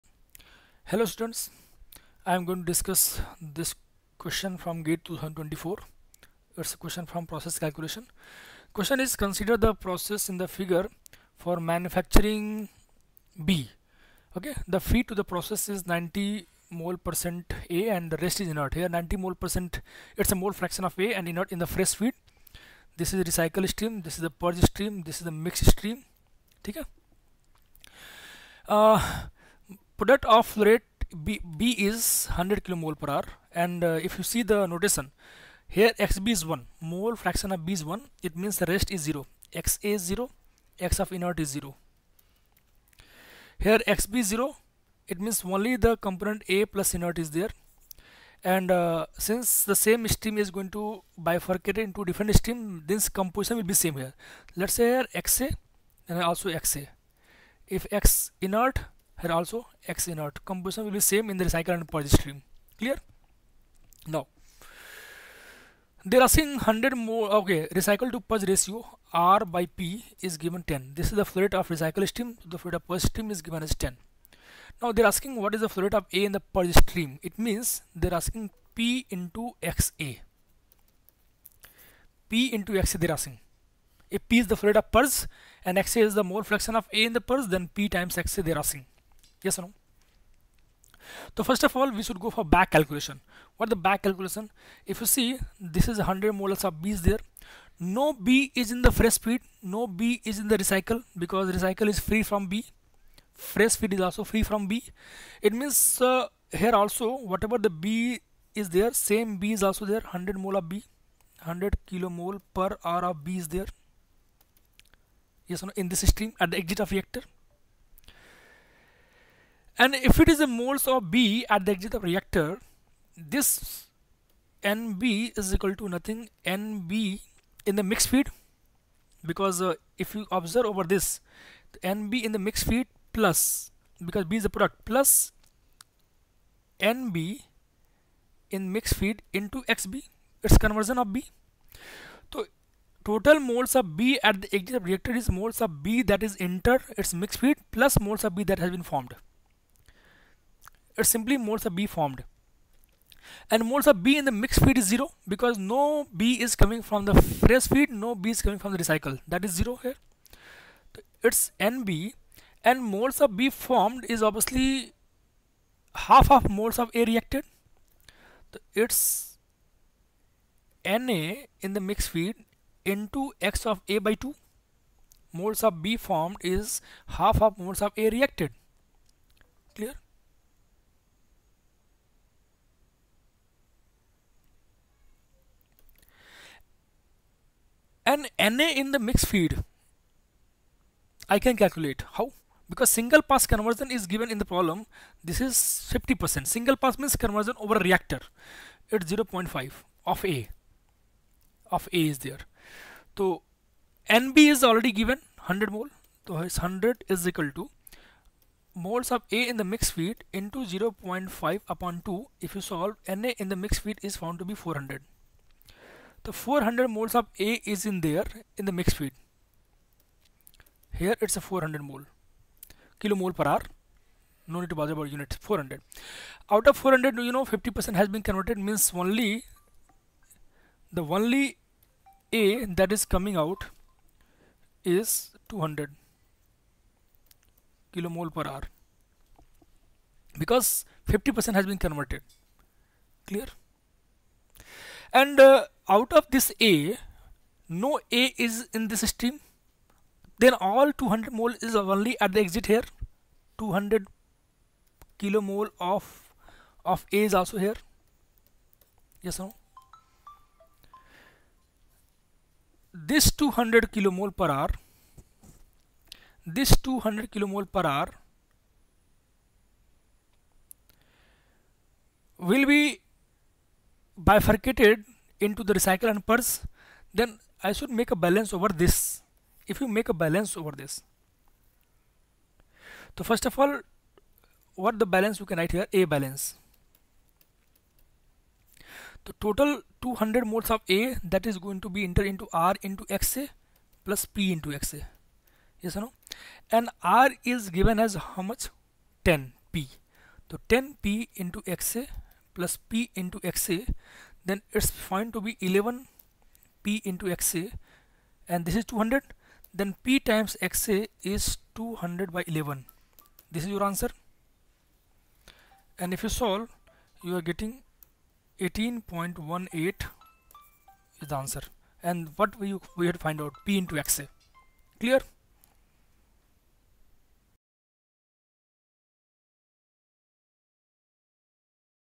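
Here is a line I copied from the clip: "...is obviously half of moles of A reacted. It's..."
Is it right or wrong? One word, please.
right.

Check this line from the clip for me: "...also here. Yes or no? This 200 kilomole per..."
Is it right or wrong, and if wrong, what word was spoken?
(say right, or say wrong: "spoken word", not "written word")
right.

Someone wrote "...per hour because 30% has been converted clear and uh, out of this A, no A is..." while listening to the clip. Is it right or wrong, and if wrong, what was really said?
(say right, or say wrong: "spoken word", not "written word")
wrong: "50", not "30".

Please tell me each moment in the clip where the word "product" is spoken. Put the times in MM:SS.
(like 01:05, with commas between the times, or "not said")
00:30, 02:14.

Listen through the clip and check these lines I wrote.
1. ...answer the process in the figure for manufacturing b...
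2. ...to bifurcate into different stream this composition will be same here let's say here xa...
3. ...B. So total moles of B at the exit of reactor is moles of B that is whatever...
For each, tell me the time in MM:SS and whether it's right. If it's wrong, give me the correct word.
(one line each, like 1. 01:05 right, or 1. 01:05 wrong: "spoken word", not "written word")
1. 00:09 wrong: "consider", not "answer"
2. 00:50 right
3. 02:21 wrong: "enter", not "whatever".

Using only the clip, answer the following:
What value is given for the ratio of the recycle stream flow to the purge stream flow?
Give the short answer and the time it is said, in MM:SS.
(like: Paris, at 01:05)
10, at 01:09.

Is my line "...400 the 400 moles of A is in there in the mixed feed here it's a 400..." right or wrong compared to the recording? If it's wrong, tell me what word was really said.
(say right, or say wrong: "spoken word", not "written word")
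right.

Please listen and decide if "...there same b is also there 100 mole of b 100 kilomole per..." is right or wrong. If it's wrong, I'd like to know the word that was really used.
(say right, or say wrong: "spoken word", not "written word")
right.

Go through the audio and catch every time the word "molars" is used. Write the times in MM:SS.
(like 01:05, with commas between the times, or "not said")
01:36.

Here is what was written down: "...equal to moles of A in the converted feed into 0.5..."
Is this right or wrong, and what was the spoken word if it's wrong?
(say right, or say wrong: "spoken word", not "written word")
wrong: "mixed", not "converted".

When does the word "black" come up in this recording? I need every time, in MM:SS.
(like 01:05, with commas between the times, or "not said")
not said.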